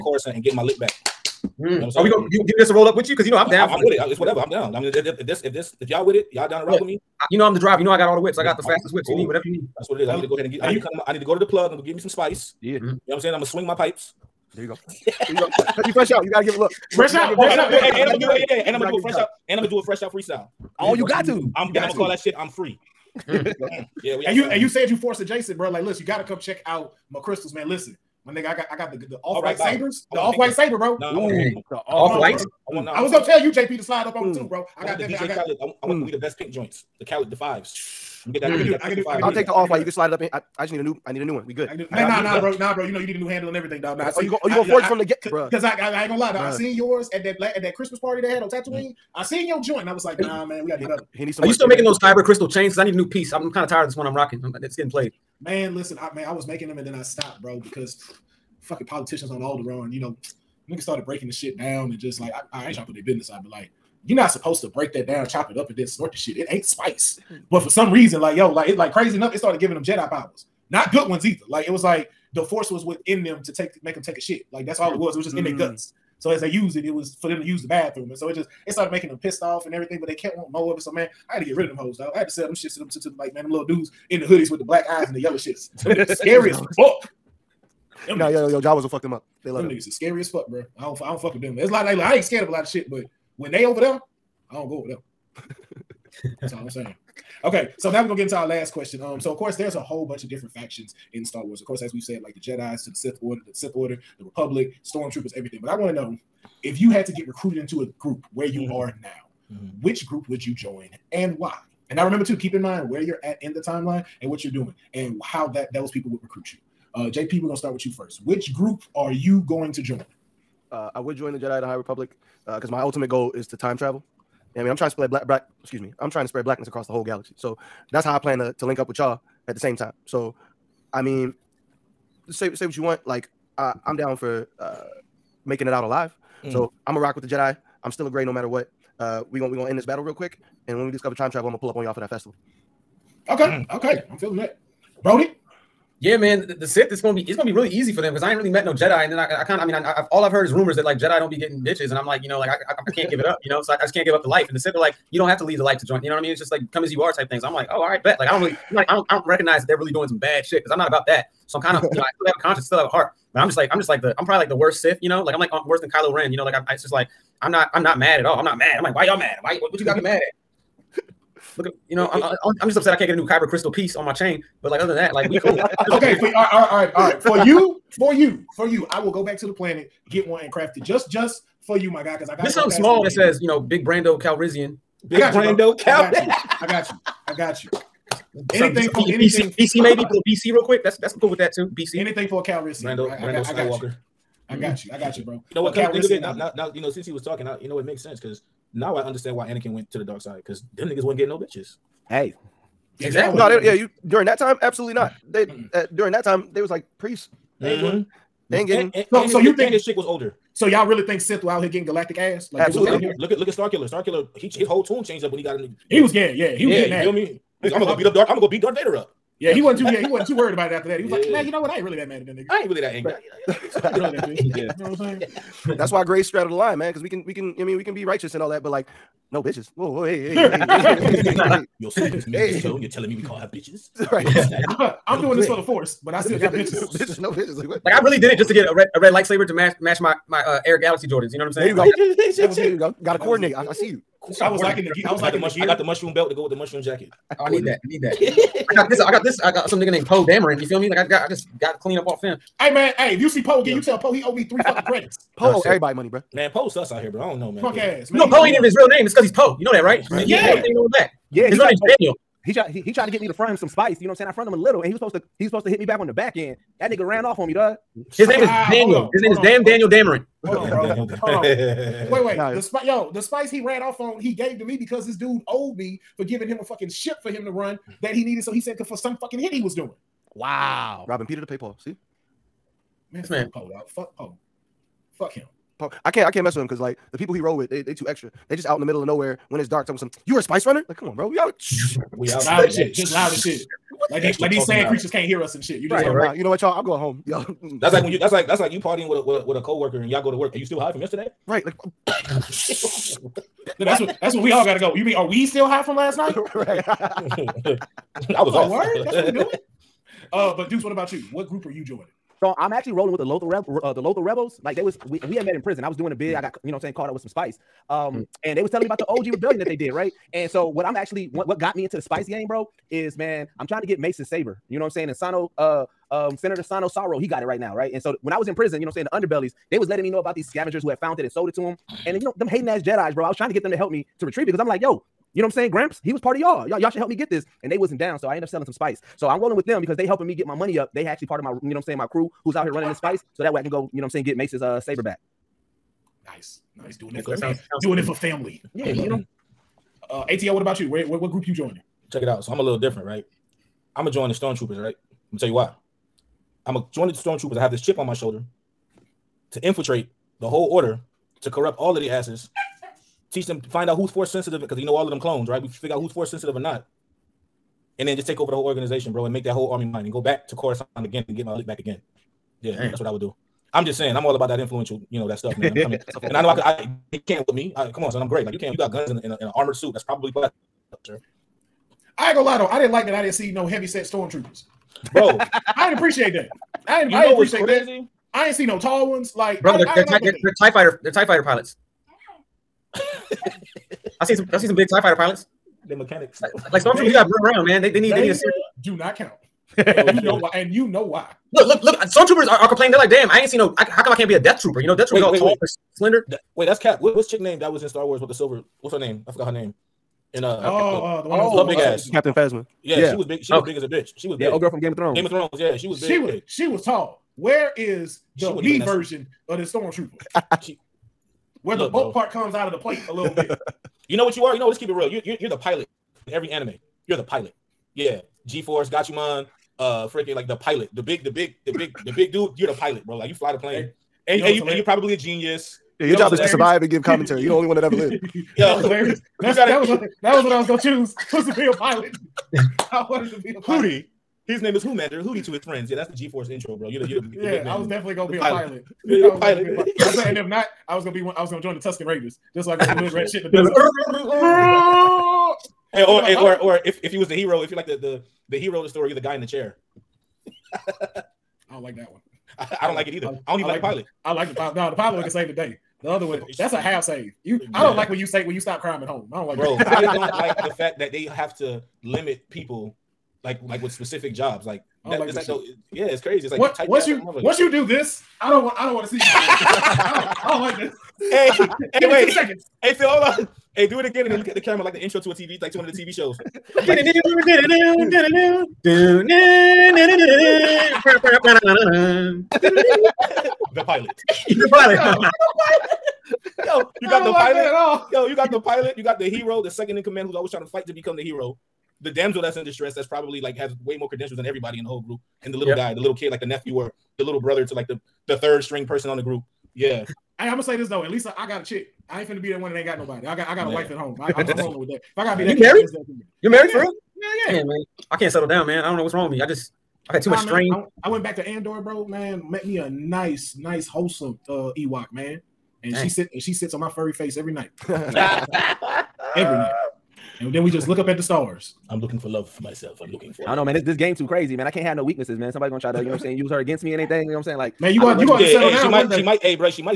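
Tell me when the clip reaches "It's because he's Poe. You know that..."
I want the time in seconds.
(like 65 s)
259 s.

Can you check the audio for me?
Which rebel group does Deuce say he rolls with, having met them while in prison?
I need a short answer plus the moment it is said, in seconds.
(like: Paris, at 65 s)
Lothal Rebels, at 314 s.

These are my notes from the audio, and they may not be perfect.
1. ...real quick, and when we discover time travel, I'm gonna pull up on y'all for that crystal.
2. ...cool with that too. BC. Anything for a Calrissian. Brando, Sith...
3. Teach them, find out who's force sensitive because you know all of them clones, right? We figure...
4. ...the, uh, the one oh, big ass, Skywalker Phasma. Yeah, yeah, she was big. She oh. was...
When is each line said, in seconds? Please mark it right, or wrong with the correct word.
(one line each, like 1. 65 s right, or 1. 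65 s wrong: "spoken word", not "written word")
1. 140 s wrong: "festival", not "crystal"
2. 191 s wrong: "Brando", not "Sith"
3. 363 s right
4. 410 s wrong: "Captain", not "Skywalker".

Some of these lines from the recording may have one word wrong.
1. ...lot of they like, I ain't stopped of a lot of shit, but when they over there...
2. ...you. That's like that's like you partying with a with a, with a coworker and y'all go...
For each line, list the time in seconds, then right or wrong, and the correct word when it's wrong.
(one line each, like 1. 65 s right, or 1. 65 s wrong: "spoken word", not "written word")
1. 91 s wrong: "scared", not "stopped"
2. 298 s right.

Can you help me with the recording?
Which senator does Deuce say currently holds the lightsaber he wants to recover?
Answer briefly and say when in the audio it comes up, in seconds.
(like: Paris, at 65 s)
Sano Sauro, at 326 s.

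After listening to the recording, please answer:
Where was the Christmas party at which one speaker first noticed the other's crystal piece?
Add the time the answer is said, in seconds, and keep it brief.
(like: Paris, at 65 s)
Tatooine, at 48 s.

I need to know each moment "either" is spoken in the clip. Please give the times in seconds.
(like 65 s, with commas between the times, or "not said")
71 s, 463 s.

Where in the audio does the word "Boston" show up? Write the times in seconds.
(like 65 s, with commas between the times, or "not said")
not said.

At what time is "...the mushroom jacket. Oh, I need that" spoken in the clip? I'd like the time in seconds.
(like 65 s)
246 s.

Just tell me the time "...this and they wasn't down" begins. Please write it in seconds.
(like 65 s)
337 s.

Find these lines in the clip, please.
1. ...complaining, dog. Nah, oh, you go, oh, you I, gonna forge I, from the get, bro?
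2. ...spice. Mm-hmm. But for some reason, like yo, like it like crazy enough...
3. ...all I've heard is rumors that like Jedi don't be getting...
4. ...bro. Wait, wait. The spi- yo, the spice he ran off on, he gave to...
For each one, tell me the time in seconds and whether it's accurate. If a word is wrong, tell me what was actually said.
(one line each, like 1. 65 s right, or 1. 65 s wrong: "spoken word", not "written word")
1. 43 s wrong: "everything", not "complaining"
2. 66 s right
3. 150 s right
4. 271 s right.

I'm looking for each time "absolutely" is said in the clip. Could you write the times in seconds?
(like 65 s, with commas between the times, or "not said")
204 s, 212 s.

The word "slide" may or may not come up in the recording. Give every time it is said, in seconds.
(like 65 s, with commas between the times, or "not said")
33 s, 39 s.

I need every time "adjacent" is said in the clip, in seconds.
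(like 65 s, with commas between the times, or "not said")
25 s.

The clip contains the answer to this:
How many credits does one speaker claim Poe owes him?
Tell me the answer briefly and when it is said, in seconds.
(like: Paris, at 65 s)
3, at 254 s.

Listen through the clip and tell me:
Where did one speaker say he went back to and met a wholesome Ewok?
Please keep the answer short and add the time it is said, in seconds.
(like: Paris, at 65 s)
Andor, at 521 s.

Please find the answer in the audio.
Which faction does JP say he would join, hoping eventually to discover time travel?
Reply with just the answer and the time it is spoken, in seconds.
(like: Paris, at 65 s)
Jedi of the High Republic, at 121 s.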